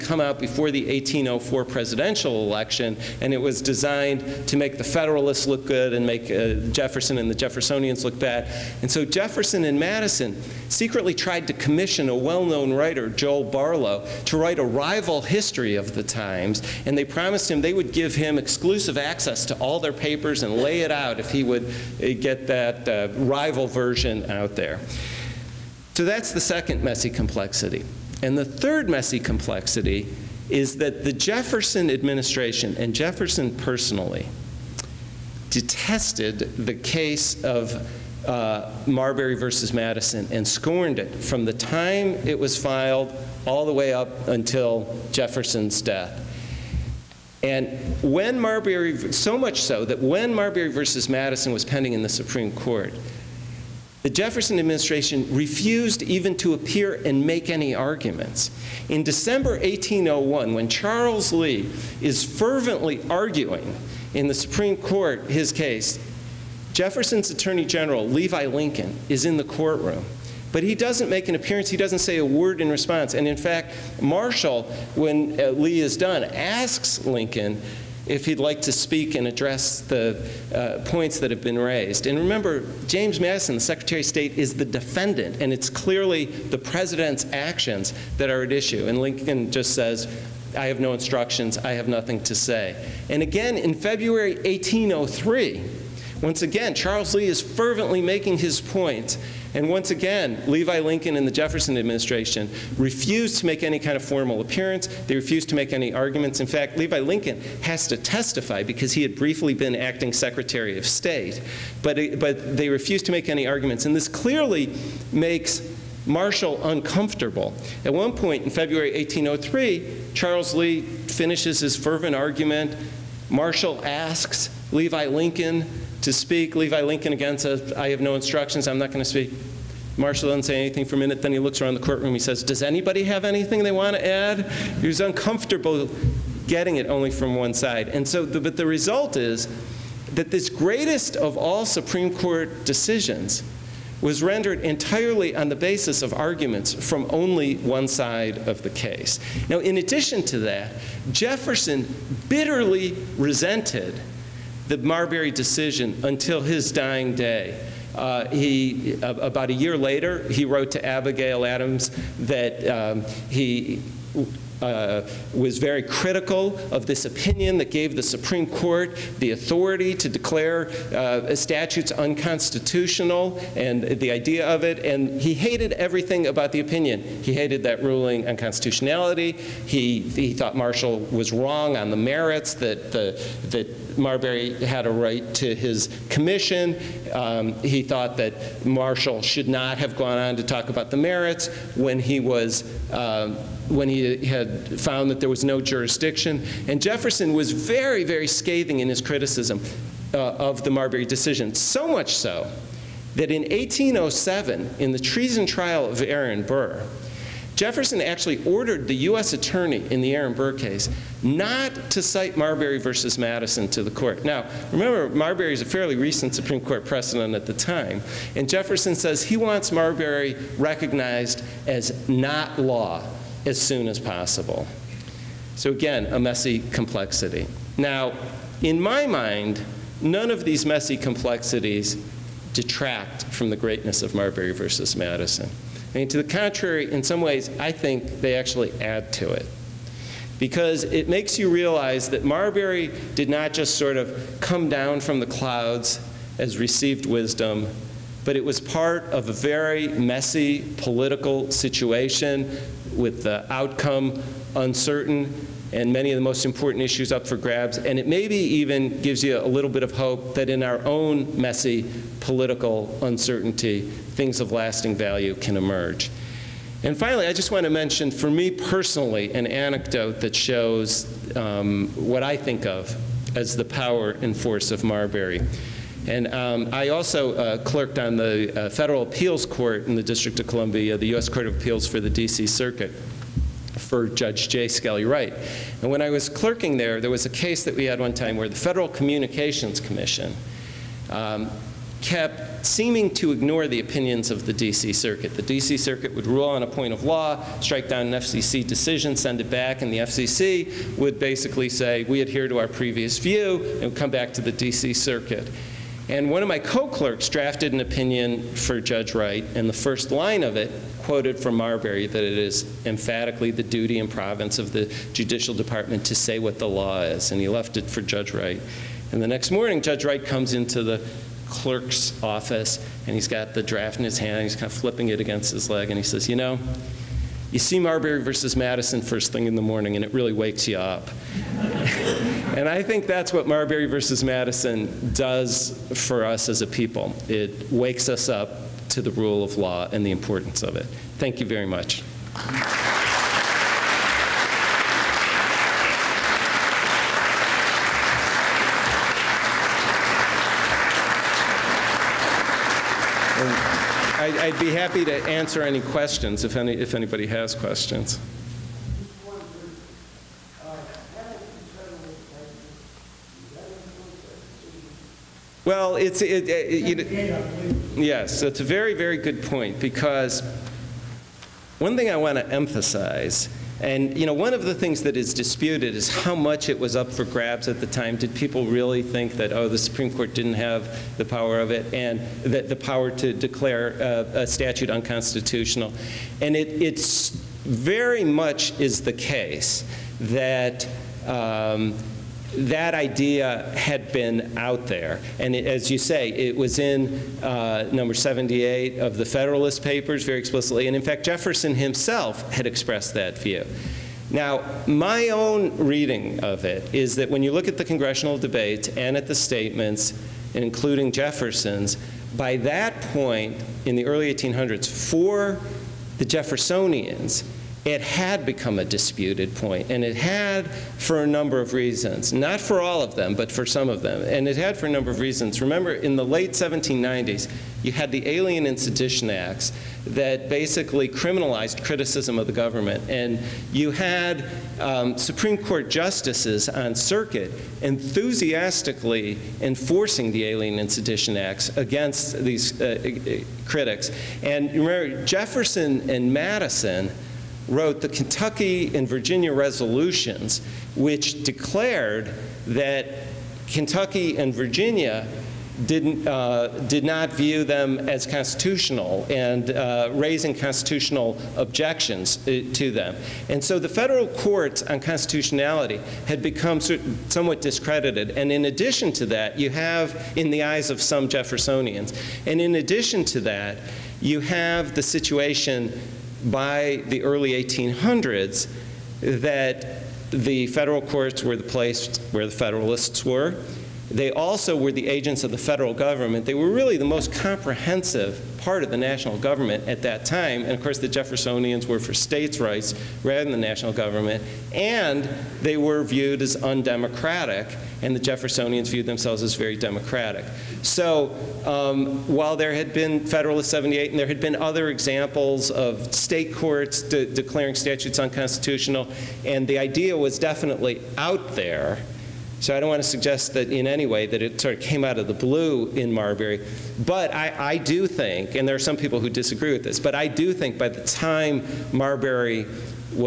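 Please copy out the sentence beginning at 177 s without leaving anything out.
He hated that ruling on constitutionality.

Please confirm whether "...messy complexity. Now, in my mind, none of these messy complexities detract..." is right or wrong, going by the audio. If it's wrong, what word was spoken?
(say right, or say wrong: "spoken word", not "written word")
right.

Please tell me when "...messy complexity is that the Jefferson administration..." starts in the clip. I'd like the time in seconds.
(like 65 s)
28 s.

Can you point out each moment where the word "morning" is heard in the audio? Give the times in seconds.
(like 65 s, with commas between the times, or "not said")
319 s, 329 s.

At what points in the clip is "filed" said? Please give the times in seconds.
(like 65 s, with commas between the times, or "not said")
42 s.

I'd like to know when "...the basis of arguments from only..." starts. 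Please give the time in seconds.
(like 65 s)
145 s.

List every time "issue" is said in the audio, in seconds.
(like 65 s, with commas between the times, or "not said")
88 s, 256 s.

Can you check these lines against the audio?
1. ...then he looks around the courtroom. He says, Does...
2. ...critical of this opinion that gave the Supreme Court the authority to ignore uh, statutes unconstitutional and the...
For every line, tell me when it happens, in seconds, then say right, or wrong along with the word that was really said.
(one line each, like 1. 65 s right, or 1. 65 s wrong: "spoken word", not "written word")
1. 131 s right
2. 165 s wrong: "declare", not "ignore".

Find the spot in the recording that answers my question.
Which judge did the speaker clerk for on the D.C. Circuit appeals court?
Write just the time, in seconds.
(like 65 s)
284 s.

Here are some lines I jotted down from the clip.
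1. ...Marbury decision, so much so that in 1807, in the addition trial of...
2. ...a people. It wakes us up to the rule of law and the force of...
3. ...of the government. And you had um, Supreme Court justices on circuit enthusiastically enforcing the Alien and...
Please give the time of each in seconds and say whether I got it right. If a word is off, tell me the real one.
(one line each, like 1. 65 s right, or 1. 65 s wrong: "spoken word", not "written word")
1. 200 s wrong: "treason", not "addition"
2. 336 s wrong: "importance", not "force"
3. 432 s right.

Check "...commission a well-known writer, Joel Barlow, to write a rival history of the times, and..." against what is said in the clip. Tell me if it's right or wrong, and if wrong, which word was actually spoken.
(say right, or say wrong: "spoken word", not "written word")
right.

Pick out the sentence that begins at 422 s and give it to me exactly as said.
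Not for all of them, but for some of them.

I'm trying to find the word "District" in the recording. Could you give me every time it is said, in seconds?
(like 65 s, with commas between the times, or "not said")
280 s.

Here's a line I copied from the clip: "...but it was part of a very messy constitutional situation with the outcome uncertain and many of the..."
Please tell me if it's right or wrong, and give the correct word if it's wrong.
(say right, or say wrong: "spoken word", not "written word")
wrong: "political", not "constitutional".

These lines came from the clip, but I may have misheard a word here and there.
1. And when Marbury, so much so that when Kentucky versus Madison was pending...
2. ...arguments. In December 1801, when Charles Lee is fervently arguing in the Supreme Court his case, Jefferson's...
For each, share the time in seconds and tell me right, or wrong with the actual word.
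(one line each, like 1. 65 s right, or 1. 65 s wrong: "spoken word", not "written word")
1. 47 s wrong: "Marbury", not "Kentucky"
2. 57 s right.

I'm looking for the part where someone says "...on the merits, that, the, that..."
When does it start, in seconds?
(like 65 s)
181 s.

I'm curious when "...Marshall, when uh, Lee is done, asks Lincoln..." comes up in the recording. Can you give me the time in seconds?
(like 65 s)
74 s.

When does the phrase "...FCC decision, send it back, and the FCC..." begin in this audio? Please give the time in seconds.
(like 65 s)
298 s.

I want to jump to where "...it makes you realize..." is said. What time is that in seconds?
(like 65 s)
240 s.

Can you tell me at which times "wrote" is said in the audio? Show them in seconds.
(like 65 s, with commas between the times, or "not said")
160 s, 447 s.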